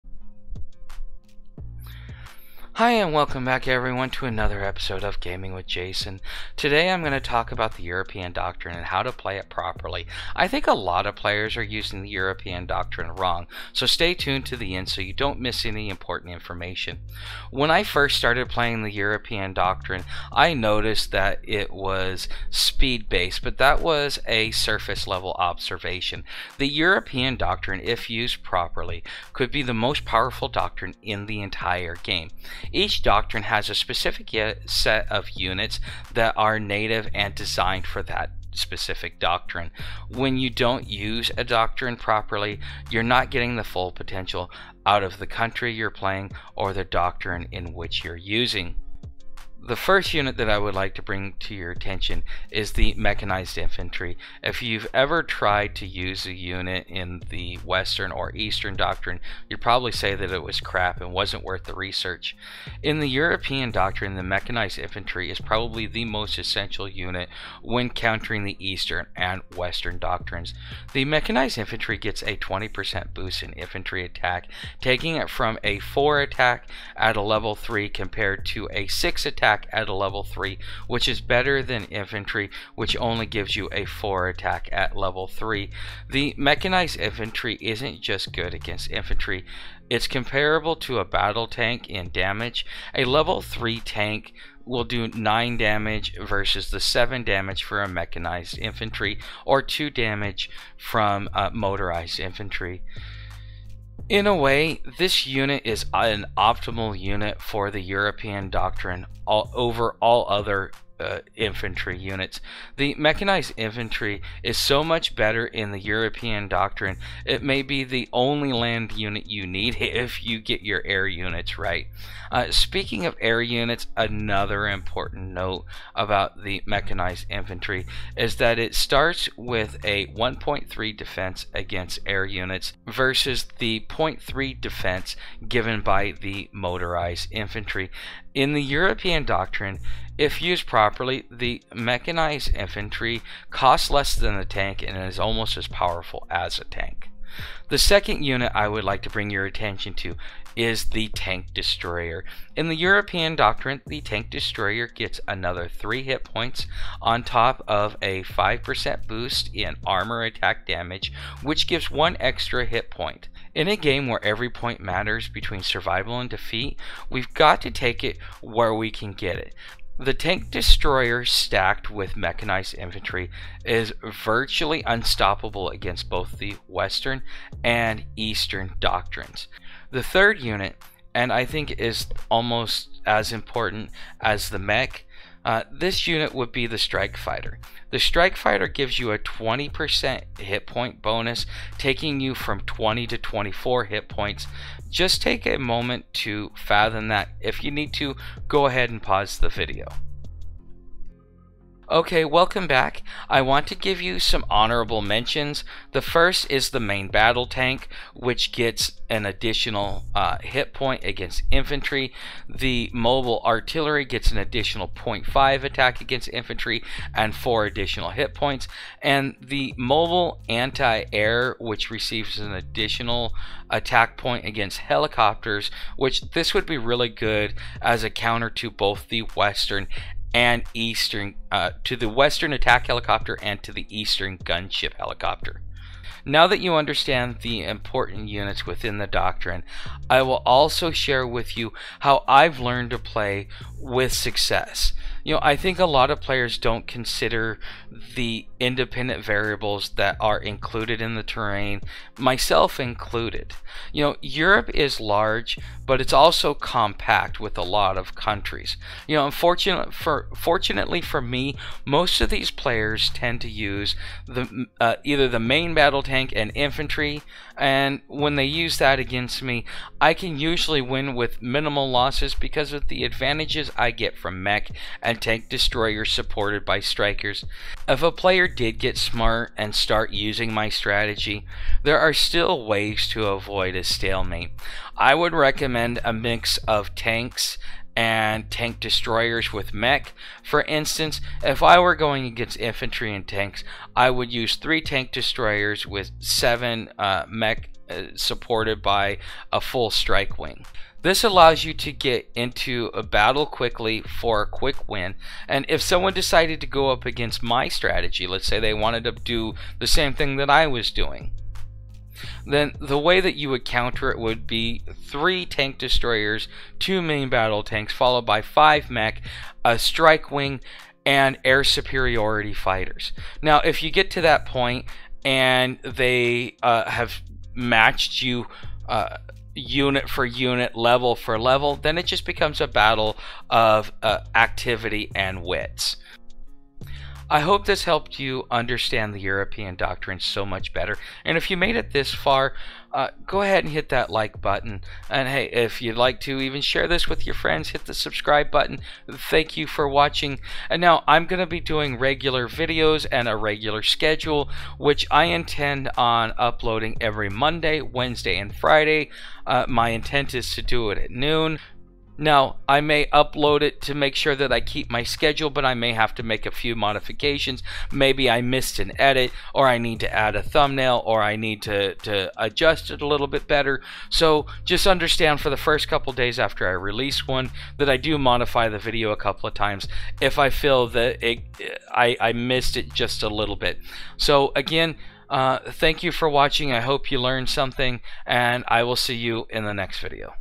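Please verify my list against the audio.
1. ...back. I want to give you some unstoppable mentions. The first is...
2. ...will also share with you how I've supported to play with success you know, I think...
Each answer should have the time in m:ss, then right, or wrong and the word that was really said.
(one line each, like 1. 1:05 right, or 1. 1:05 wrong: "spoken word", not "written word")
1. 3:22 wrong: "honorable", not "unstoppable"
2. 4:00 wrong: "learned", not "supported".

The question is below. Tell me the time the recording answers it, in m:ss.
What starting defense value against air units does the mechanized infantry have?
2:10.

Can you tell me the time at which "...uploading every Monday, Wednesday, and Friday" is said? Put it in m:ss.
5:56.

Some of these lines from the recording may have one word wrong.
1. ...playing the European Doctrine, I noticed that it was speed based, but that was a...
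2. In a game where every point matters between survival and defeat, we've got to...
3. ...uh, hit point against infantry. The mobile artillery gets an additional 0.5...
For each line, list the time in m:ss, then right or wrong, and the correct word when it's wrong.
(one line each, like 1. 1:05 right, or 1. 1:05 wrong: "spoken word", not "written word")
1. 0:18 right
2. 2:43 right
3. 3:30 right.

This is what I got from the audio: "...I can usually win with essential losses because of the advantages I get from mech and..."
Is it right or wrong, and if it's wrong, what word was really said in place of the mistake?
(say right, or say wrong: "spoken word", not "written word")
wrong: "minimal", not "essential".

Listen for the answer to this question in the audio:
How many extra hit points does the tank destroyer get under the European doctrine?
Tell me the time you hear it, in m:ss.
2:35.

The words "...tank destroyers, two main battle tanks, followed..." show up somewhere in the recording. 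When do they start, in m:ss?
5:15.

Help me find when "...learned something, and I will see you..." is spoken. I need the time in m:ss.
6:27.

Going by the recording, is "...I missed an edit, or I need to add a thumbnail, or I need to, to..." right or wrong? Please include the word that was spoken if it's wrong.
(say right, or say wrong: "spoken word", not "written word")
right.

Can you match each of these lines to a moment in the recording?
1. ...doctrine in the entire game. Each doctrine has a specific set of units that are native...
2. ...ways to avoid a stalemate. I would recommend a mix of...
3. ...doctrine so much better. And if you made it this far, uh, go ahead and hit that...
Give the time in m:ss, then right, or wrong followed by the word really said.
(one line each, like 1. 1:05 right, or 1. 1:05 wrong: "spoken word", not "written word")
1. 0:30 right
2. 4:42 right
3. 5:39 right.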